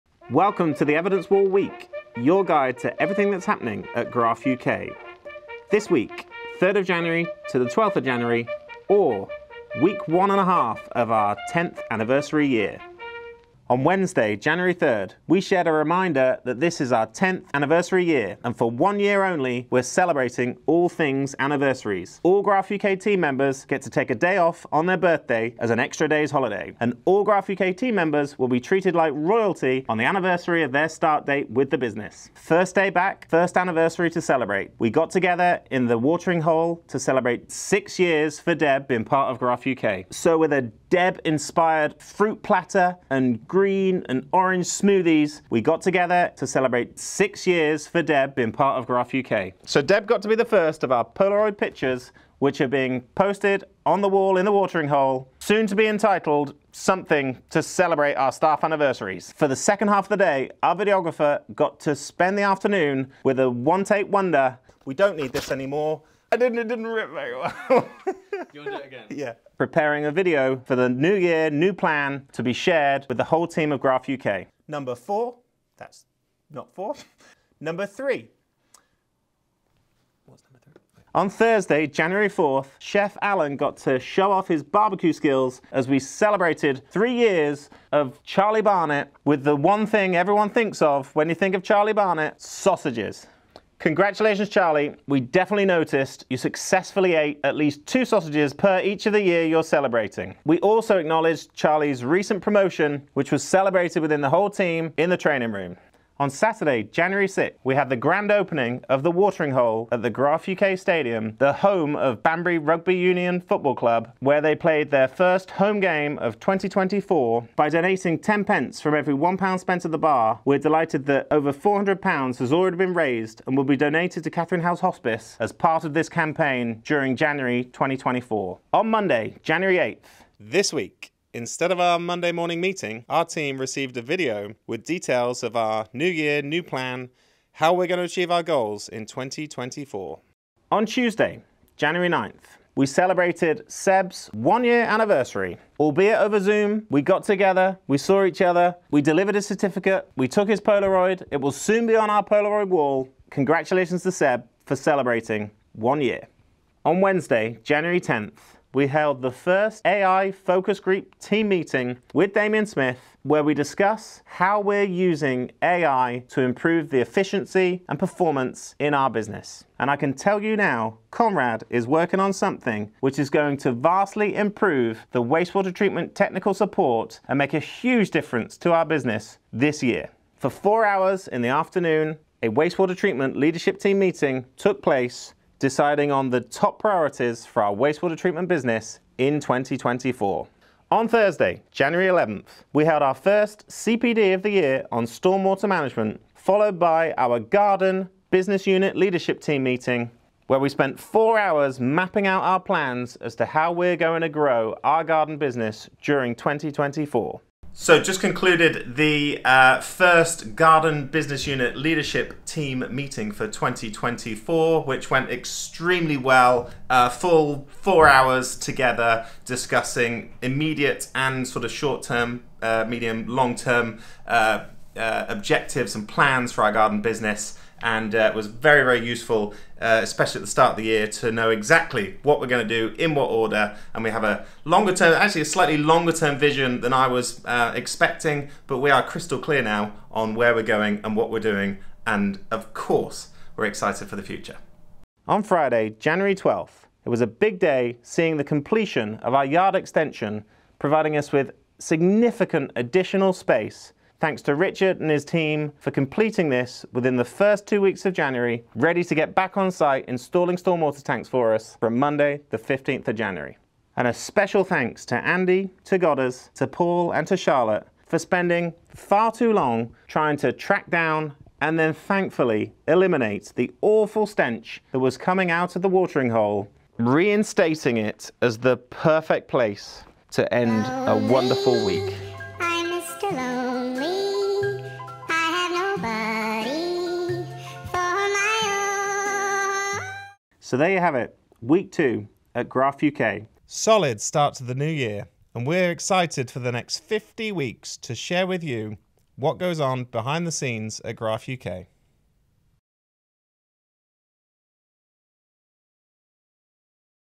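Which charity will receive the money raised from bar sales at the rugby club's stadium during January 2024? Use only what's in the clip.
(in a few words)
Catherine House Hospice.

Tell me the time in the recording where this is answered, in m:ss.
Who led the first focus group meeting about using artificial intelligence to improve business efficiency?
2:42.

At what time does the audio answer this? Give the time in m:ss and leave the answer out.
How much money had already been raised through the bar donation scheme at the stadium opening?
2:01.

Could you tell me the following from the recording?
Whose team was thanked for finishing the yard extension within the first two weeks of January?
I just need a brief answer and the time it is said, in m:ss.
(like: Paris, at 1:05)
Richard, at 4:14.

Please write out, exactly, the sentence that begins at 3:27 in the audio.
So, just concluded the uh, first Garden Business Unit Leadership Team meeting for 2024, which went extremely well.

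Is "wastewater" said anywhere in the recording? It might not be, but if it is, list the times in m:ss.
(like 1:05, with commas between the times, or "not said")
2:55, 3:02, 3:07.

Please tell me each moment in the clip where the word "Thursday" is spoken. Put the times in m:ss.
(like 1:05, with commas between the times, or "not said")
1:21, 3:11.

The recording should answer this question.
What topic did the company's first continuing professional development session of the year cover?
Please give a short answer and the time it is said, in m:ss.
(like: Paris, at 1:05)
Stormwater management, at 3:15.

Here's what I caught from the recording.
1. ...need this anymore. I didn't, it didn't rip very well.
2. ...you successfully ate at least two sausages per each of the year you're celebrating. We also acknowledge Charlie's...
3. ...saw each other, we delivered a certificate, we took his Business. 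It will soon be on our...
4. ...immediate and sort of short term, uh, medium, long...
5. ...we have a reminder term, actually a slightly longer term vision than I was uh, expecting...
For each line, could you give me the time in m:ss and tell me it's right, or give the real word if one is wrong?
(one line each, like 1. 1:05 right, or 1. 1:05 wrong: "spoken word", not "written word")
1. 1:05 right
2. 1:36 right
3. 2:27 wrong: "Polaroid", not "Business"
4. 3:40 right
5. 3:54 wrong: "longer", not "reminder".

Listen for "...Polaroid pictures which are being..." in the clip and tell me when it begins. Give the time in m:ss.
0:51.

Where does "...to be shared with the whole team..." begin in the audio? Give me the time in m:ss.
1:12.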